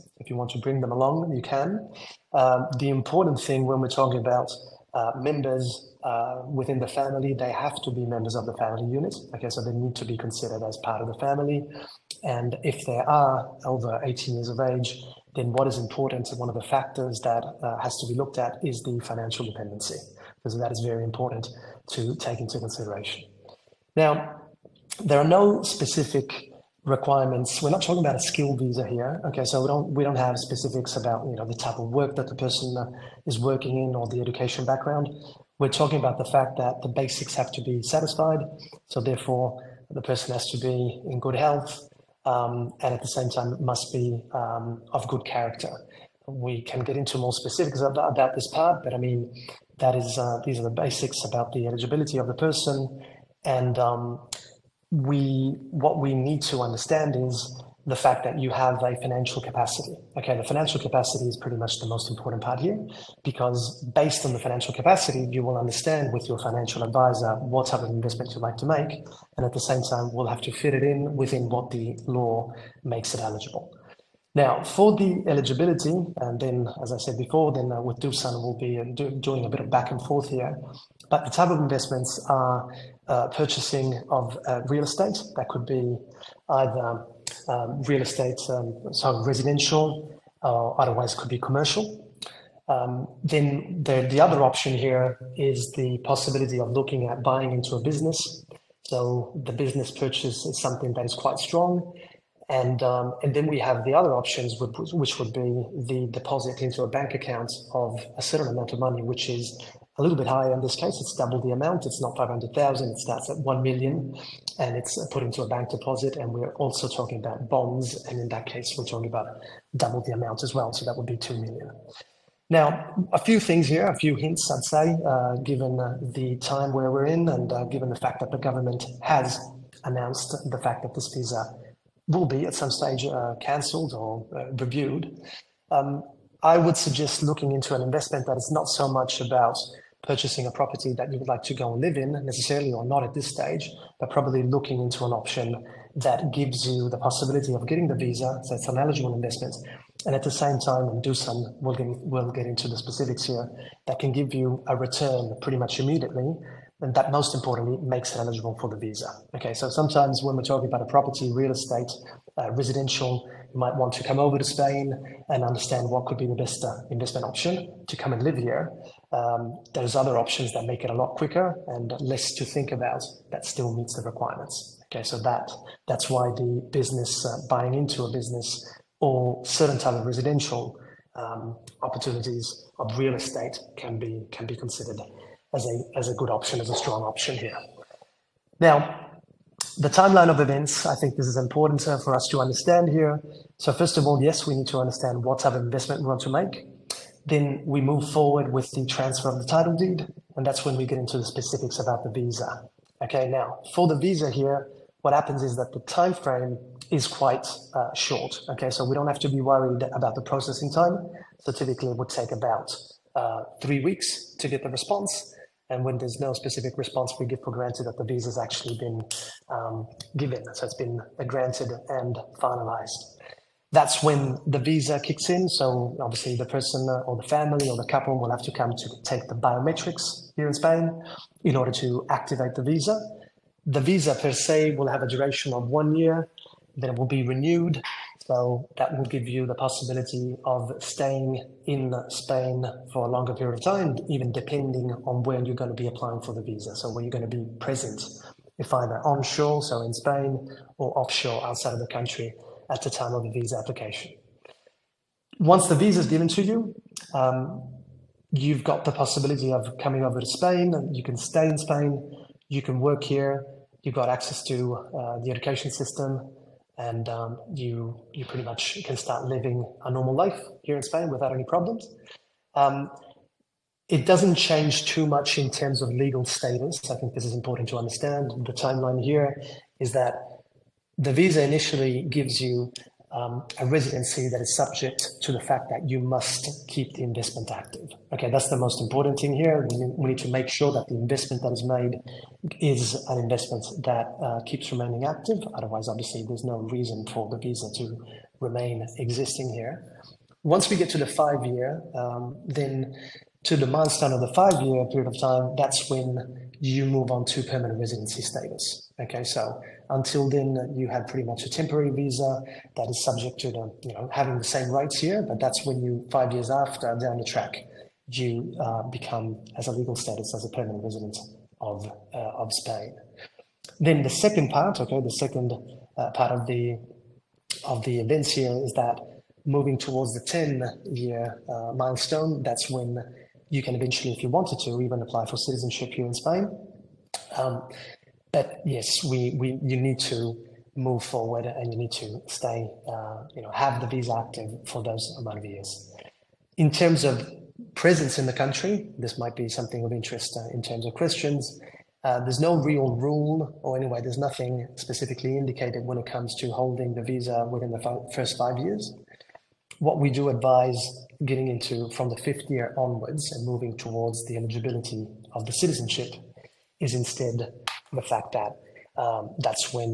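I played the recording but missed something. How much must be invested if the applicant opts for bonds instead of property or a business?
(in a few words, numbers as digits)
2 million.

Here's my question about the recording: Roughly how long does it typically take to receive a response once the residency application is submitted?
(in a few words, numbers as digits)
Three weeks.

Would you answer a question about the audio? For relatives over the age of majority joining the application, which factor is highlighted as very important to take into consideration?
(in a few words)
Financial dependency.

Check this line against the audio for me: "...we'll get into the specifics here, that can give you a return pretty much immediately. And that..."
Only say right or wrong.
right.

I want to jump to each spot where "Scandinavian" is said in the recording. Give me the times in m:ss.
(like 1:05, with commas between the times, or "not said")
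not said.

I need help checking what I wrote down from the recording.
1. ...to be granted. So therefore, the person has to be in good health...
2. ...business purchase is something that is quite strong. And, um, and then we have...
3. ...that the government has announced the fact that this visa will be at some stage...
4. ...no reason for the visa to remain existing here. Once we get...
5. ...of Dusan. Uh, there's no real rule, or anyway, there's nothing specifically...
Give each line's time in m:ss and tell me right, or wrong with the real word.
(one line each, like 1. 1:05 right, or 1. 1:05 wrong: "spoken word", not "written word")
1. 0:37 wrong: "satisfied", not "granted"
2. 1:39 right
3. 2:08 right
4. 4:56 right
5. 5:50 wrong: "Christians", not "Dusan".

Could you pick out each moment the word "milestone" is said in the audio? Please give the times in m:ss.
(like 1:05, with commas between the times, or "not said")
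5:03, 5:31.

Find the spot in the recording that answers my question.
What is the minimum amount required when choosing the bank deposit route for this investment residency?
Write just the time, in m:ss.
1:53.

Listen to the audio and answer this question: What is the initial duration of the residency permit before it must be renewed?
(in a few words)
One year.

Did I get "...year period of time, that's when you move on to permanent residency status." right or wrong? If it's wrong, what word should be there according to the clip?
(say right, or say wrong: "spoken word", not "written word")
right.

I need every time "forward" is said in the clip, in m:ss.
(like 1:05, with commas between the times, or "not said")
3:18, 5:41.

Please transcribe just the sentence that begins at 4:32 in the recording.
Um, it doesn't change too much in terms of legal status.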